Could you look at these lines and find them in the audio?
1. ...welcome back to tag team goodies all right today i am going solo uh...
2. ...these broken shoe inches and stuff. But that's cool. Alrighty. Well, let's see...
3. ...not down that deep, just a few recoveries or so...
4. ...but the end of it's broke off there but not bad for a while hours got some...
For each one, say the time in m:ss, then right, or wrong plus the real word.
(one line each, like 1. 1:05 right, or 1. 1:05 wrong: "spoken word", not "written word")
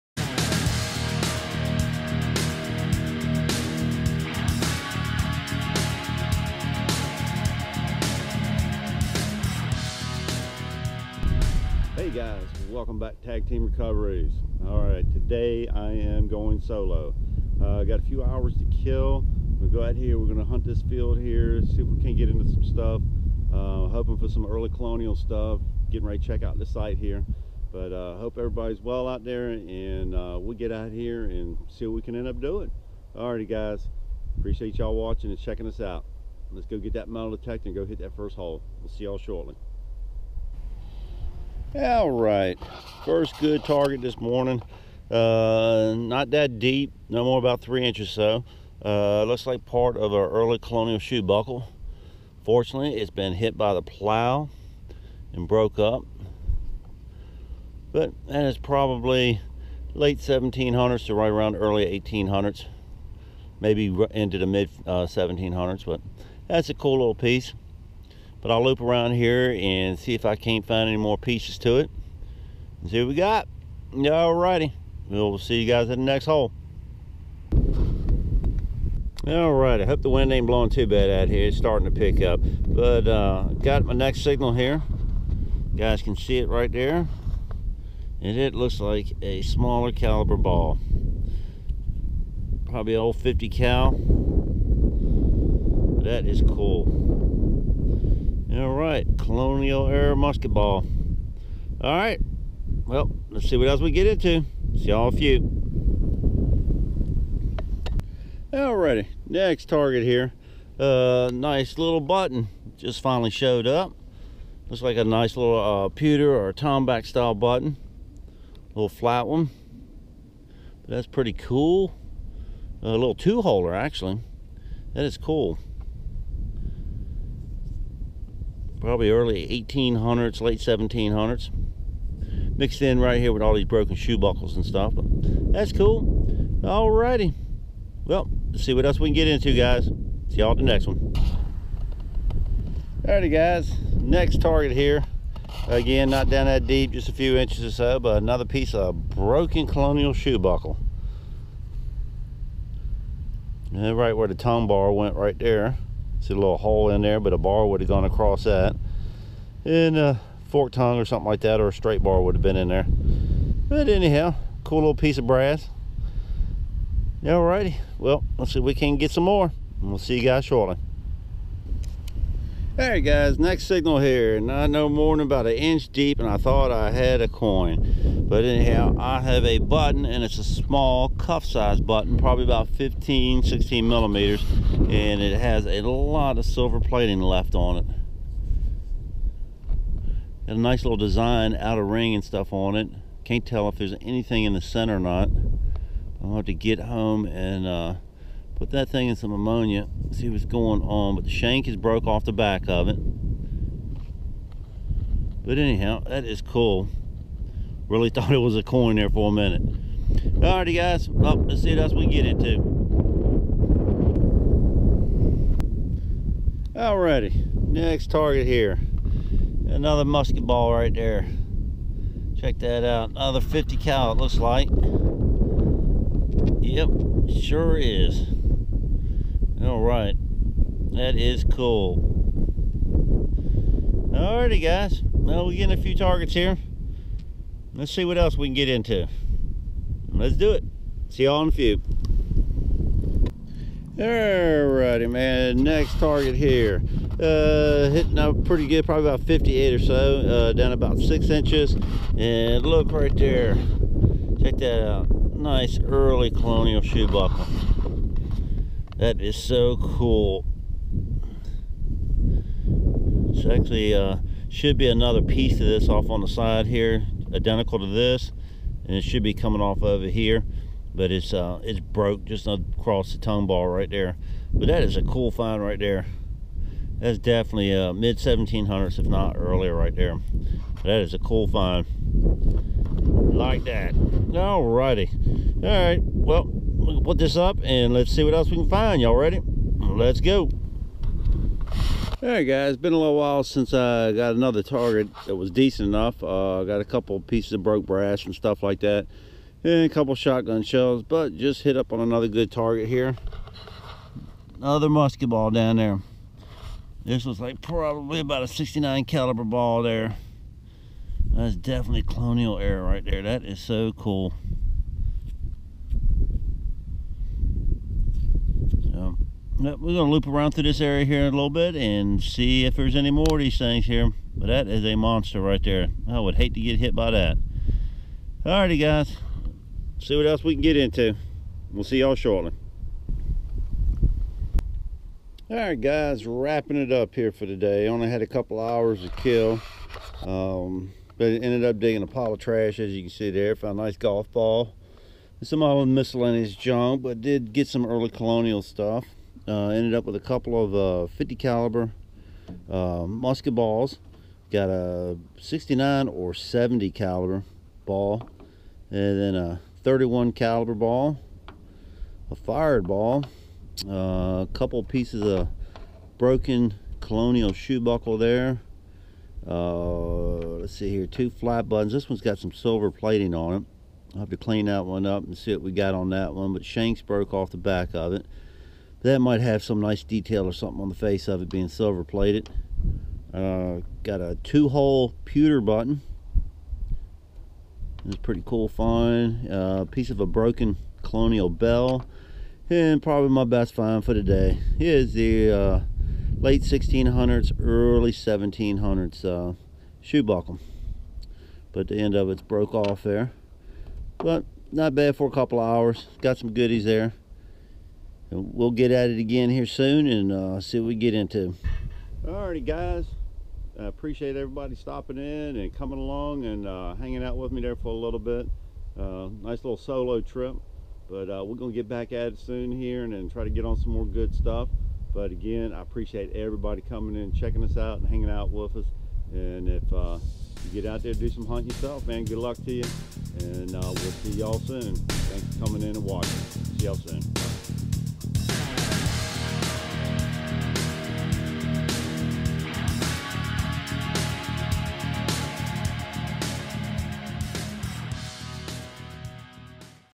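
1. 0:12 wrong: "recoveries", not "goodies"
2. 2:13 wrong: "buckles", not "inches"
3. 2:26 wrong: "inches", not "recoveries"
4. 6:41 wrong: "couple", not "while".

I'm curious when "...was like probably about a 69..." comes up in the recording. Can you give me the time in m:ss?
5:07.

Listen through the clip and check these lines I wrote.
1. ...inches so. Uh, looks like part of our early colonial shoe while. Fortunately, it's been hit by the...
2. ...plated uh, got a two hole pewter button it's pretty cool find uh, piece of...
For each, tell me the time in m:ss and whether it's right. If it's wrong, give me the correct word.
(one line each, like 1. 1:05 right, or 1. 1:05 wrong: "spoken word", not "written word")
1. 0:47 wrong: "buckle", not "while"
2. 6:22 right.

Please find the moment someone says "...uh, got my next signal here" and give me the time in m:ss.
1:23.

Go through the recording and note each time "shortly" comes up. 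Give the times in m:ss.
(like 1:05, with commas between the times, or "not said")
0:39, 2:50, 5:32.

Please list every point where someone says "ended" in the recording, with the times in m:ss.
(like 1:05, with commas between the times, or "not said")
5:41, 5:49.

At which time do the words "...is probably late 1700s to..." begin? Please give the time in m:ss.
0:58.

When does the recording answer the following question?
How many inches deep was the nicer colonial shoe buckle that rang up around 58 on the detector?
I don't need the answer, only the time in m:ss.
4:10.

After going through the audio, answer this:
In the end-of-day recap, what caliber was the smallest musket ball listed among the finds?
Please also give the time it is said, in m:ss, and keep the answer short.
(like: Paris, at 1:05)
31 caliber, at 5:59.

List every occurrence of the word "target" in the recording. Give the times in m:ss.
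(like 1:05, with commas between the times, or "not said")
0:43, 1:49, 2:24, 3:38, 3:55, 4:05, 4:54, 5:02.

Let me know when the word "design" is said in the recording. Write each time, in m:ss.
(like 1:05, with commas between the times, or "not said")
3:10.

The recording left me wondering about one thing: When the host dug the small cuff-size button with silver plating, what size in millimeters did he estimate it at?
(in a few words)
15-16 millimeters.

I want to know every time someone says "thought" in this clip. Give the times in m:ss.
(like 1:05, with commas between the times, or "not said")
2:56, 3:28.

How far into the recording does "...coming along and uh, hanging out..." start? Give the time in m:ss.
6:55.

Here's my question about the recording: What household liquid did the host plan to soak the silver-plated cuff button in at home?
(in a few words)
ammonia.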